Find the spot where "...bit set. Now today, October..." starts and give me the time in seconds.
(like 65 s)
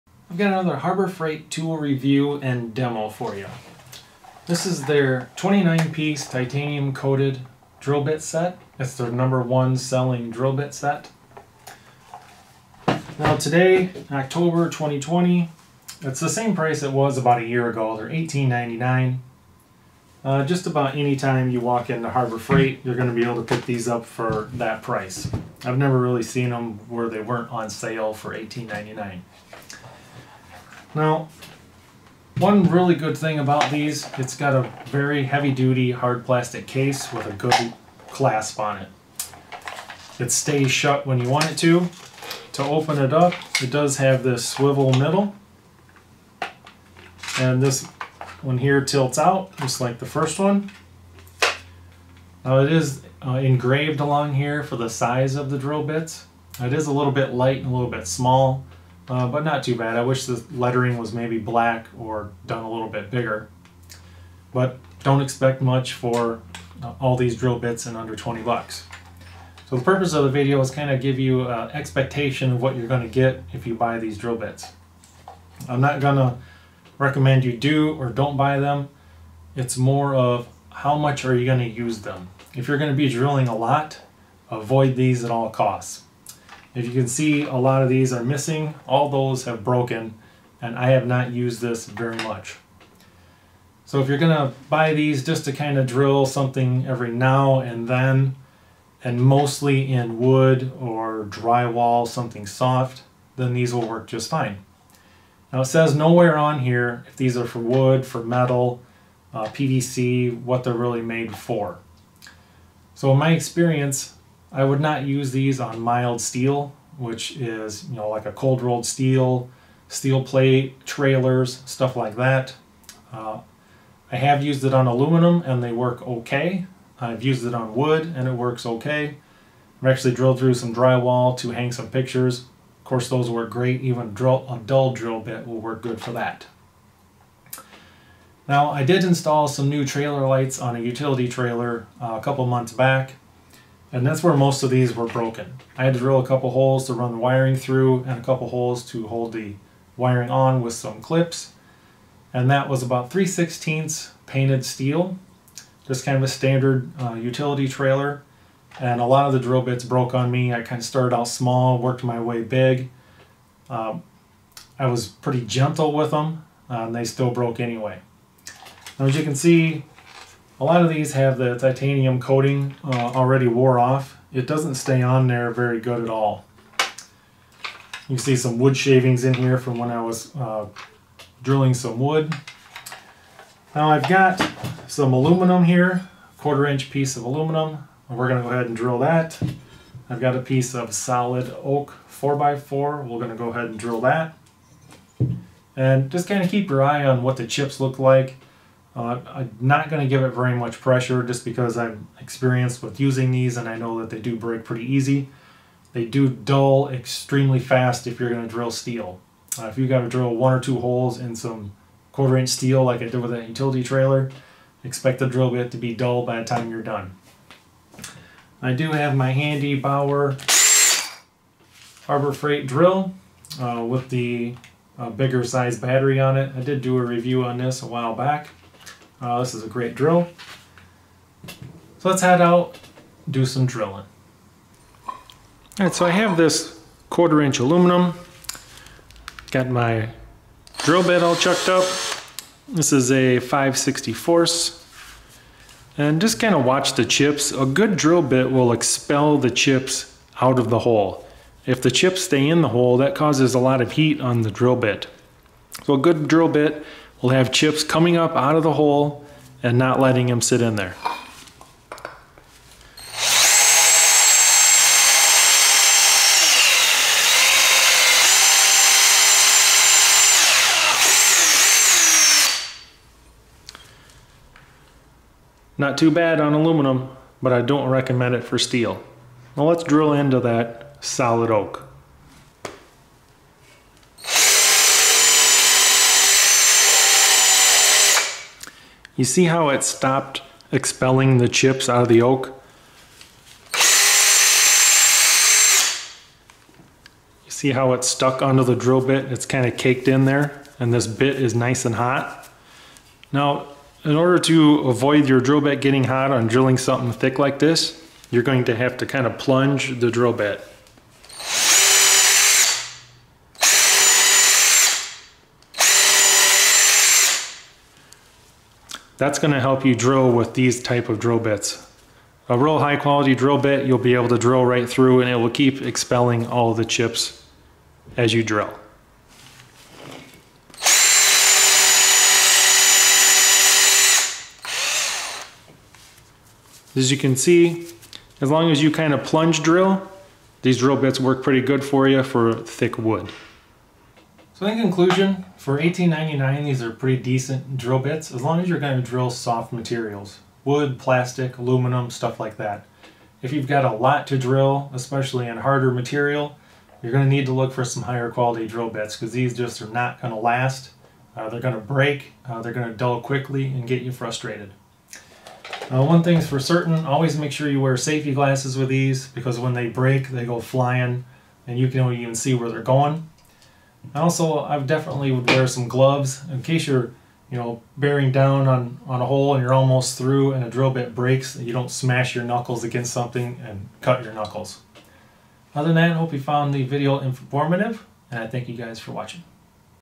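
10 s.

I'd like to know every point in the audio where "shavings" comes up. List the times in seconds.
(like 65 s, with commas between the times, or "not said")
178 s.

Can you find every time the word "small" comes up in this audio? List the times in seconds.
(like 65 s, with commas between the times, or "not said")
58 s, 161 s.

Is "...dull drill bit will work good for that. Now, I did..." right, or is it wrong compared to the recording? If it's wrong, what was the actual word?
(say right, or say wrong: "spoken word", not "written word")
right.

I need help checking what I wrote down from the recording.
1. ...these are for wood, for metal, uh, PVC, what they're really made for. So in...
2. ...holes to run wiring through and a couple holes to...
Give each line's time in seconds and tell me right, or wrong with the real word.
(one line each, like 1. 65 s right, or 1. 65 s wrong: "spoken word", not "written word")
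1. 107 s right
2. 146 s right.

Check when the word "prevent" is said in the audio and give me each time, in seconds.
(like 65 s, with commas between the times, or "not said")
not said.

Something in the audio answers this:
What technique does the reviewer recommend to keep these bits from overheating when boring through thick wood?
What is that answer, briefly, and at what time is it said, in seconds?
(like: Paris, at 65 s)
plunge the drill bit, at 309 s.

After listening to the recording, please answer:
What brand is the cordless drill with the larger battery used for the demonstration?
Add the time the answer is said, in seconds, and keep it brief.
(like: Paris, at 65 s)
Bauer, at 219 s.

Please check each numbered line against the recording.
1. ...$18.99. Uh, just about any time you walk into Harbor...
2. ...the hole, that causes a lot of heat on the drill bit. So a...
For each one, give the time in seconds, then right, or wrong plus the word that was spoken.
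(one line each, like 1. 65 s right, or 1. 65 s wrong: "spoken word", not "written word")
1. 18 s right
2. 252 s right.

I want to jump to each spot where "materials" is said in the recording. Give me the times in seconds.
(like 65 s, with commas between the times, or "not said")
349 s, 355 s.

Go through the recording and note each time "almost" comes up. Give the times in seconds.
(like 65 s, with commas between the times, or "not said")
379 s.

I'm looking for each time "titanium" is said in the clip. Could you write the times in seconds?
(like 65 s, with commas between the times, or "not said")
6 s, 171 s.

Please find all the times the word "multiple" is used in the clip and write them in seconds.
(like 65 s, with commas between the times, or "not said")
not said.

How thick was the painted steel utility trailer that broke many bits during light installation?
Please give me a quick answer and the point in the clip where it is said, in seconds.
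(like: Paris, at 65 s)
3/16, at 153 s.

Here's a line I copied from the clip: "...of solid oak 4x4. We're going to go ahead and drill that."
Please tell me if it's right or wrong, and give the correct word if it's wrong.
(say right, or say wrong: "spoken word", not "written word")
right.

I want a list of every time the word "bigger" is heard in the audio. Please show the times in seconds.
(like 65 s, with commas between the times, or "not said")
63 s, 225 s.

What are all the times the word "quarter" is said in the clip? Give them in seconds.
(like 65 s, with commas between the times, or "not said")
186 s, 212 s, 237 s.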